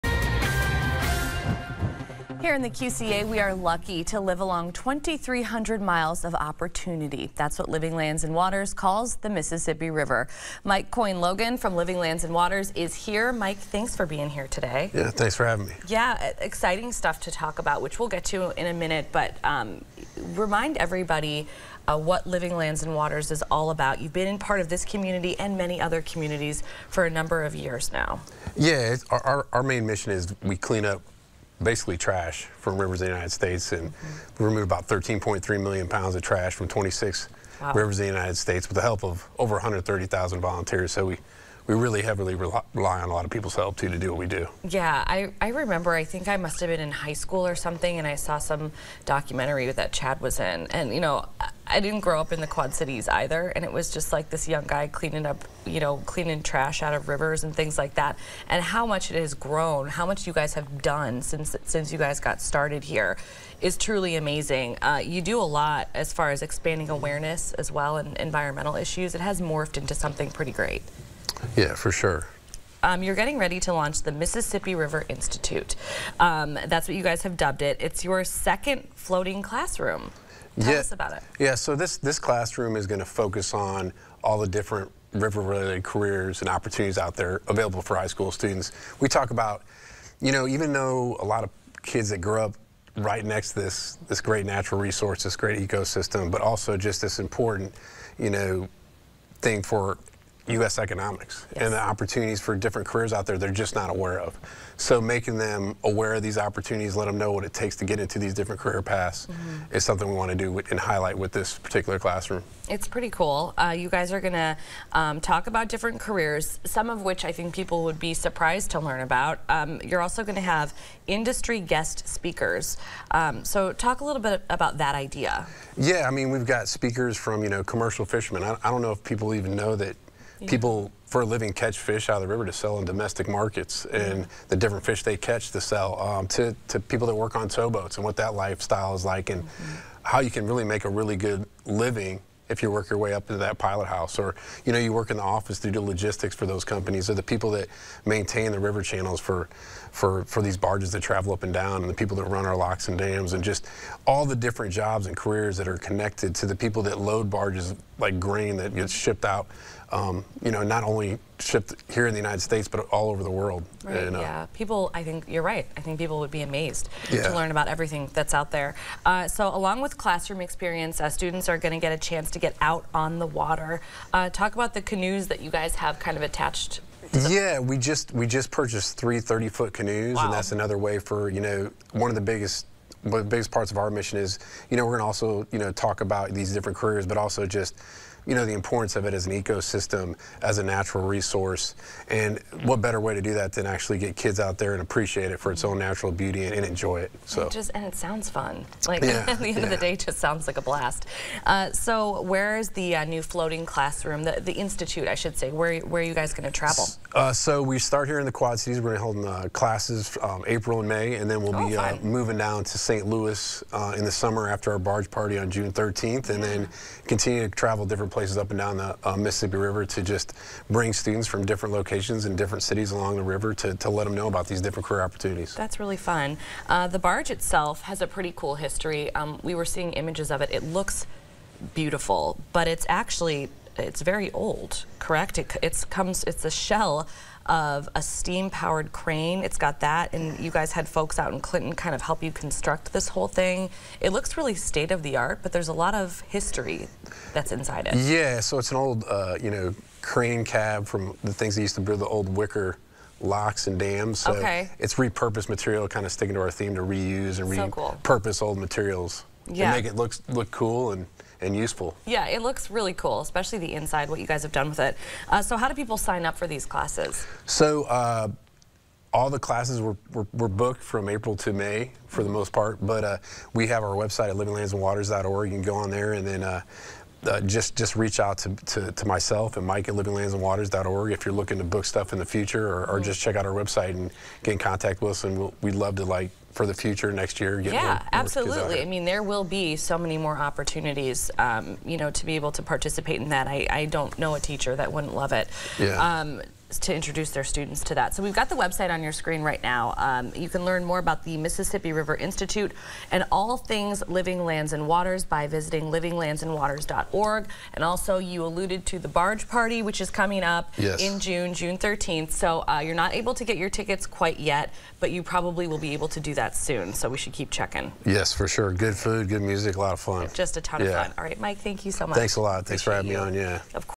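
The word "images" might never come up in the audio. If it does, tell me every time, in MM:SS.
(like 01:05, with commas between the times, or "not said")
03:49.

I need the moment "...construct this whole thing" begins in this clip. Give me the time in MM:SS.
04:02.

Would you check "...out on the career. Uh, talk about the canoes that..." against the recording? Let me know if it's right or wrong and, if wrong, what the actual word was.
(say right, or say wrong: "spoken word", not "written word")
wrong: "water", not "career".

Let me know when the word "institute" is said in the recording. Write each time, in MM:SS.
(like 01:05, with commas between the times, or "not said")
01:15, 03:24, 05:02.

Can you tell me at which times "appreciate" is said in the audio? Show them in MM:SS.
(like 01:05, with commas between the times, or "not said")
03:14, 05:22.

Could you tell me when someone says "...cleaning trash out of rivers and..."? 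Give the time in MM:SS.
00:56.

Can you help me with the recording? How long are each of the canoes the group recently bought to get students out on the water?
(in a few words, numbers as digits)
30 feet.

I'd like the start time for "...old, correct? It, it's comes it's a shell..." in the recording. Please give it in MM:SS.
03:54.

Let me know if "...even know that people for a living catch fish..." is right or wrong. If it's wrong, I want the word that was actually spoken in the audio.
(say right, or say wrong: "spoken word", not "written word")
right.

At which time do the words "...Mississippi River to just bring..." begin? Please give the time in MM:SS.
03:39.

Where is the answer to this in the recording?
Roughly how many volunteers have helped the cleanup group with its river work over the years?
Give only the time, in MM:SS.
00:39.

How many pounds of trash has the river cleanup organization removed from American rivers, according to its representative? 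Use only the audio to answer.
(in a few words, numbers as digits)
13.3 million pounds.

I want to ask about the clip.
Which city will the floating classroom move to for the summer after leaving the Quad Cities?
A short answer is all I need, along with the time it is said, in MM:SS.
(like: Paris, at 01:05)
St. Louis, at 03:32.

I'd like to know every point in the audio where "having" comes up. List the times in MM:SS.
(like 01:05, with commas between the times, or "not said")
00:15, 05:23.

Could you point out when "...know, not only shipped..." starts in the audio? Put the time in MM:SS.
02:40.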